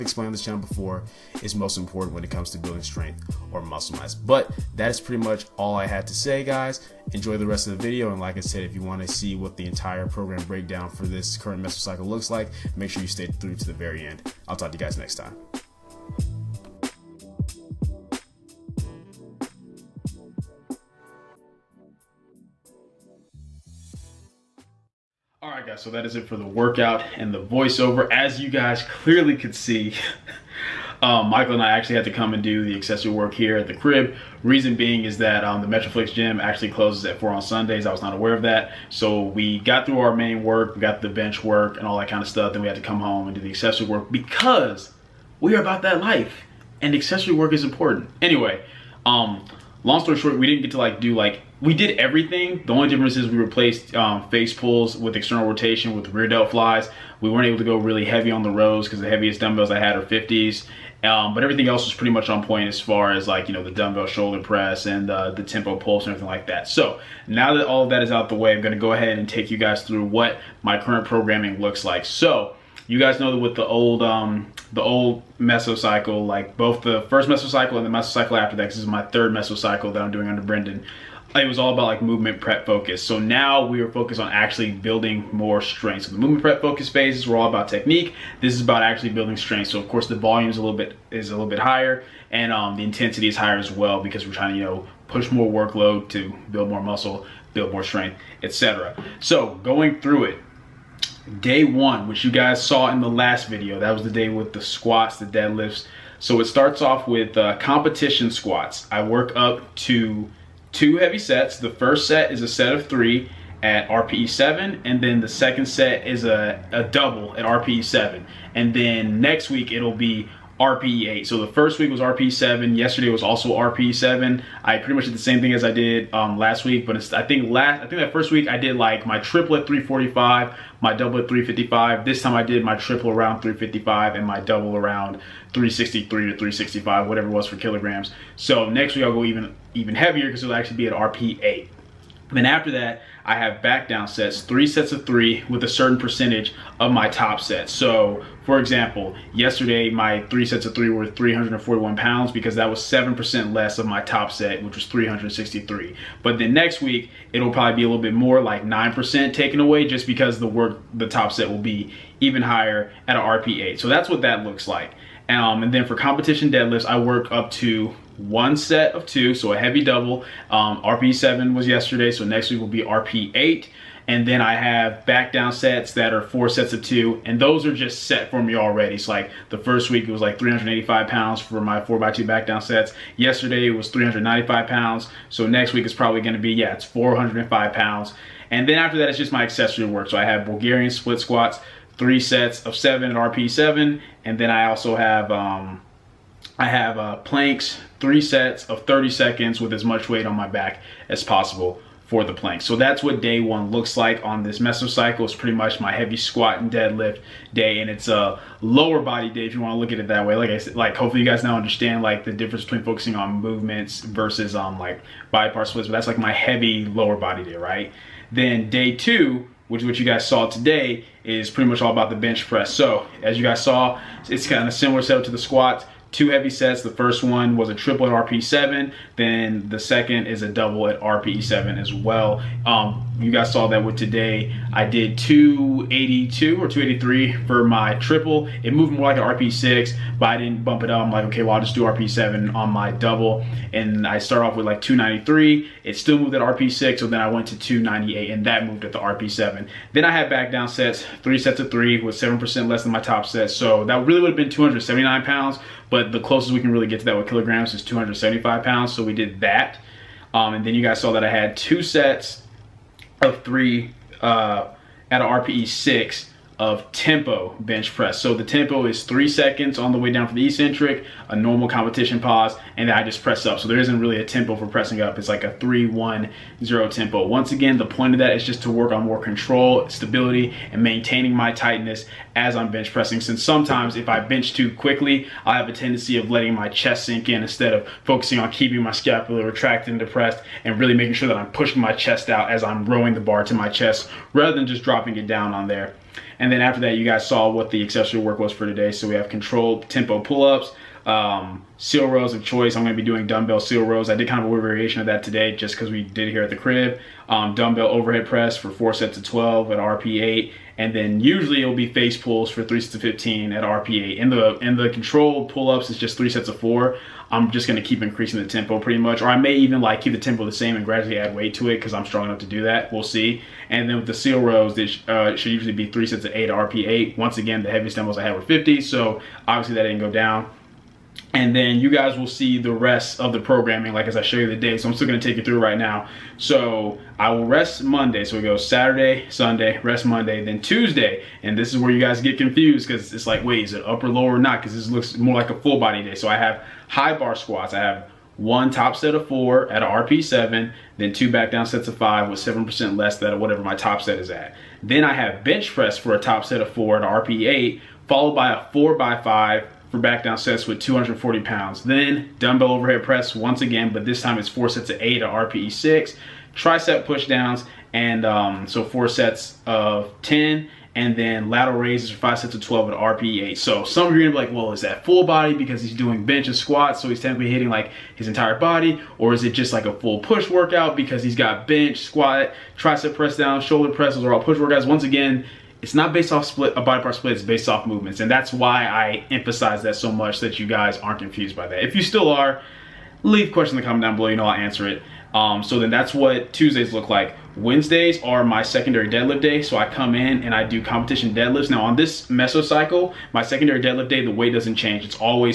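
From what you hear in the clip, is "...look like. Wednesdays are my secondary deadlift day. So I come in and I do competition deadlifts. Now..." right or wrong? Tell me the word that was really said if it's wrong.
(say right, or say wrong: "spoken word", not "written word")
right.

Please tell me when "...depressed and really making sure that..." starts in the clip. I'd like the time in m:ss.
4:49.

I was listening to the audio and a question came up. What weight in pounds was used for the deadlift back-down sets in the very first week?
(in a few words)
385 pounds.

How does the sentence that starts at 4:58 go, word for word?
So we have controlled tempo pull-ups, um, seal rows of choice.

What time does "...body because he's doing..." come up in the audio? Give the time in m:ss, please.
6:15.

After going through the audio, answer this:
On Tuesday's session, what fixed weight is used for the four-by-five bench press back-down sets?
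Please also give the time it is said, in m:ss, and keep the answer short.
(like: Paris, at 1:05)
240 pounds, at 6:00.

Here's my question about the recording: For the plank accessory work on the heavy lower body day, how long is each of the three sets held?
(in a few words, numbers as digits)
30 seconds.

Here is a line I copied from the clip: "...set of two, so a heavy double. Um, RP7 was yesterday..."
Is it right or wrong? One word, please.
right.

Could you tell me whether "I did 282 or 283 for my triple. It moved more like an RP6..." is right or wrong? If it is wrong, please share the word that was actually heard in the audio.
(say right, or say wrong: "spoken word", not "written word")
right.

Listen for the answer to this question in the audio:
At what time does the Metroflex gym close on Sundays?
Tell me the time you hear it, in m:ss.
0:36.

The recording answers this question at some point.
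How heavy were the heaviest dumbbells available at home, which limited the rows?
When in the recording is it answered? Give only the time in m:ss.
1:00.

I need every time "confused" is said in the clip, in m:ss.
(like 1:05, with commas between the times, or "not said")
5:42, 6:31.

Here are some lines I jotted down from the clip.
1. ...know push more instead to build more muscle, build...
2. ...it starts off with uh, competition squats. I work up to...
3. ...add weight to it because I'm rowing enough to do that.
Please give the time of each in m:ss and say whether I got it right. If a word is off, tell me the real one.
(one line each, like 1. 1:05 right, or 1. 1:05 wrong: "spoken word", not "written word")
1. 1:34 wrong: "workload", not "instead"
2. 1:46 right
3. 5:21 wrong: "strong", not "rowing".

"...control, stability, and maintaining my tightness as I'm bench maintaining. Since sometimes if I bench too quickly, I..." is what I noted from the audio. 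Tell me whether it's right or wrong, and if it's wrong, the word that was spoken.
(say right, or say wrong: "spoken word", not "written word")
wrong: "pressing", not "maintaining".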